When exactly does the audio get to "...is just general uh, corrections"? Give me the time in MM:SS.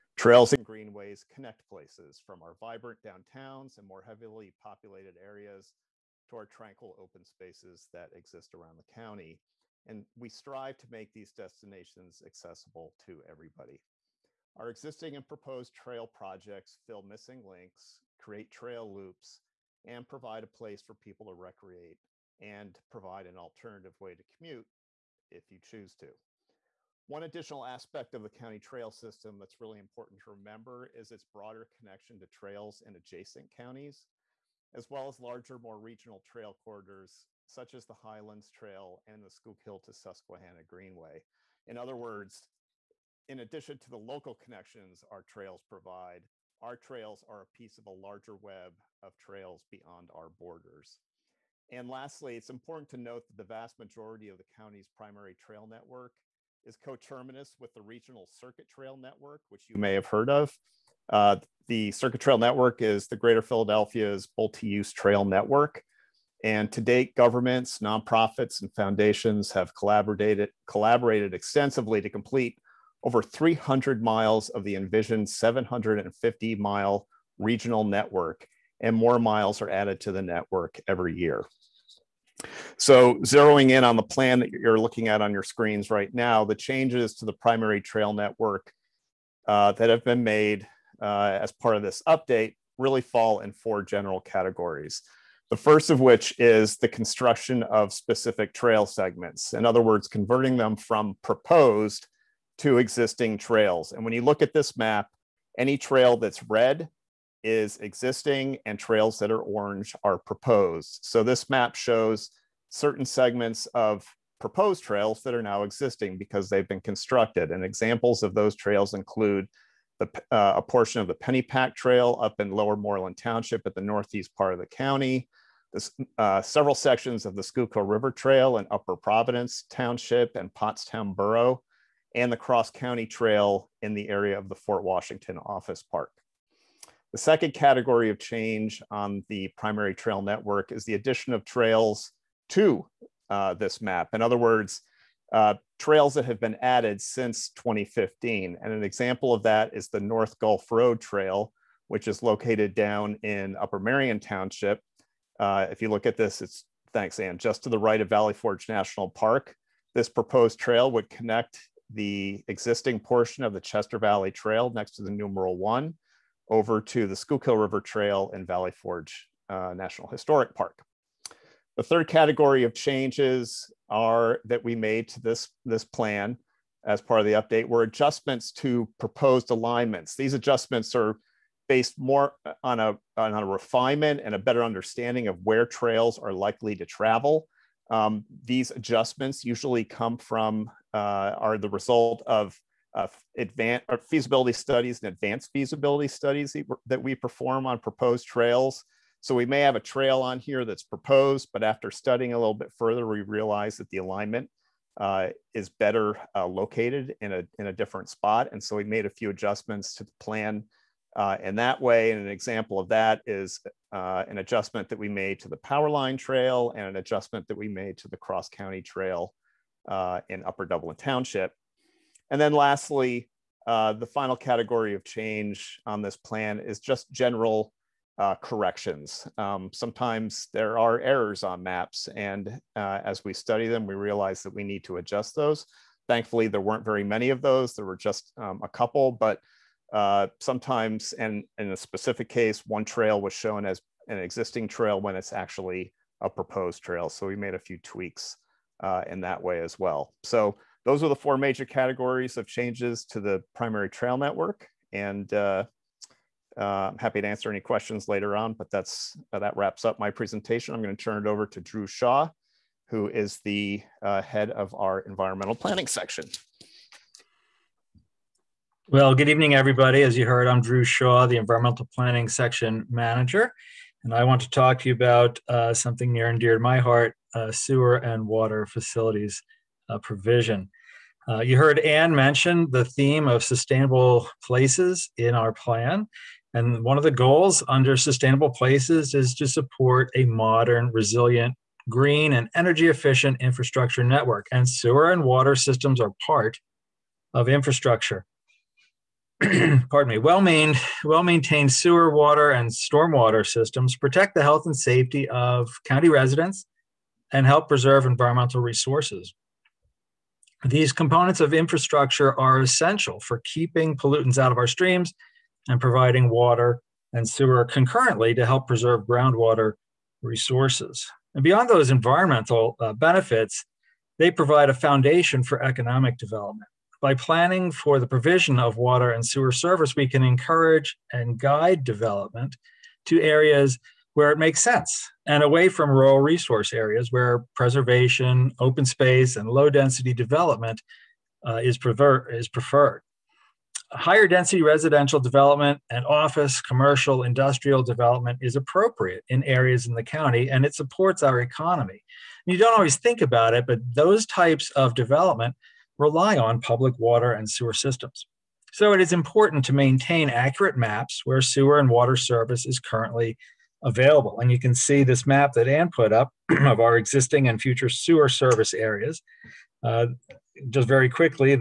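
03:46.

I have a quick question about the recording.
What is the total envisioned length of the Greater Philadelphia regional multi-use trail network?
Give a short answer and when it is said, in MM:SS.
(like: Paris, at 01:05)
750 miles, at 01:15.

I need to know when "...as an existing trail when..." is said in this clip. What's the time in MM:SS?
04:03.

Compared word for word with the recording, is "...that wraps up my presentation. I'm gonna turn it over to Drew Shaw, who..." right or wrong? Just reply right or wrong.
right.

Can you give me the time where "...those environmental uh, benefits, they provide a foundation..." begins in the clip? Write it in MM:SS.
05:21.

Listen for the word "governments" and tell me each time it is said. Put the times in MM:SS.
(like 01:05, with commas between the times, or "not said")
01:07.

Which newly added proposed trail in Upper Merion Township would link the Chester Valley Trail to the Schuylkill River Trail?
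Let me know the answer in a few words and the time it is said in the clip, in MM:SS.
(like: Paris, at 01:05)
North Gulf Road Trail, at 02:29.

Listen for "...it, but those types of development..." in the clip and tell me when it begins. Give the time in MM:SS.
05:53.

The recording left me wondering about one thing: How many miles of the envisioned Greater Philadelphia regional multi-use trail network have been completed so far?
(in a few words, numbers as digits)
over 300.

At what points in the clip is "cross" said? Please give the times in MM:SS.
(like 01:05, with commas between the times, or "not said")
02:12, 03:38.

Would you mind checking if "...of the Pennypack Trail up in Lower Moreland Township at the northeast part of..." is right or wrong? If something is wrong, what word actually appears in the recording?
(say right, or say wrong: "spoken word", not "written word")
right.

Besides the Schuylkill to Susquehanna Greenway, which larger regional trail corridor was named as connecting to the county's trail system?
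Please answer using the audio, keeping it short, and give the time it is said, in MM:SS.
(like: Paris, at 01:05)
Highlands Trail, at 00:37.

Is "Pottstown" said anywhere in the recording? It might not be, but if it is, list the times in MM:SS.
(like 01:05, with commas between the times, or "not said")
02:10.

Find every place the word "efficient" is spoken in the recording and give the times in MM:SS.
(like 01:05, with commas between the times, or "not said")
04:52.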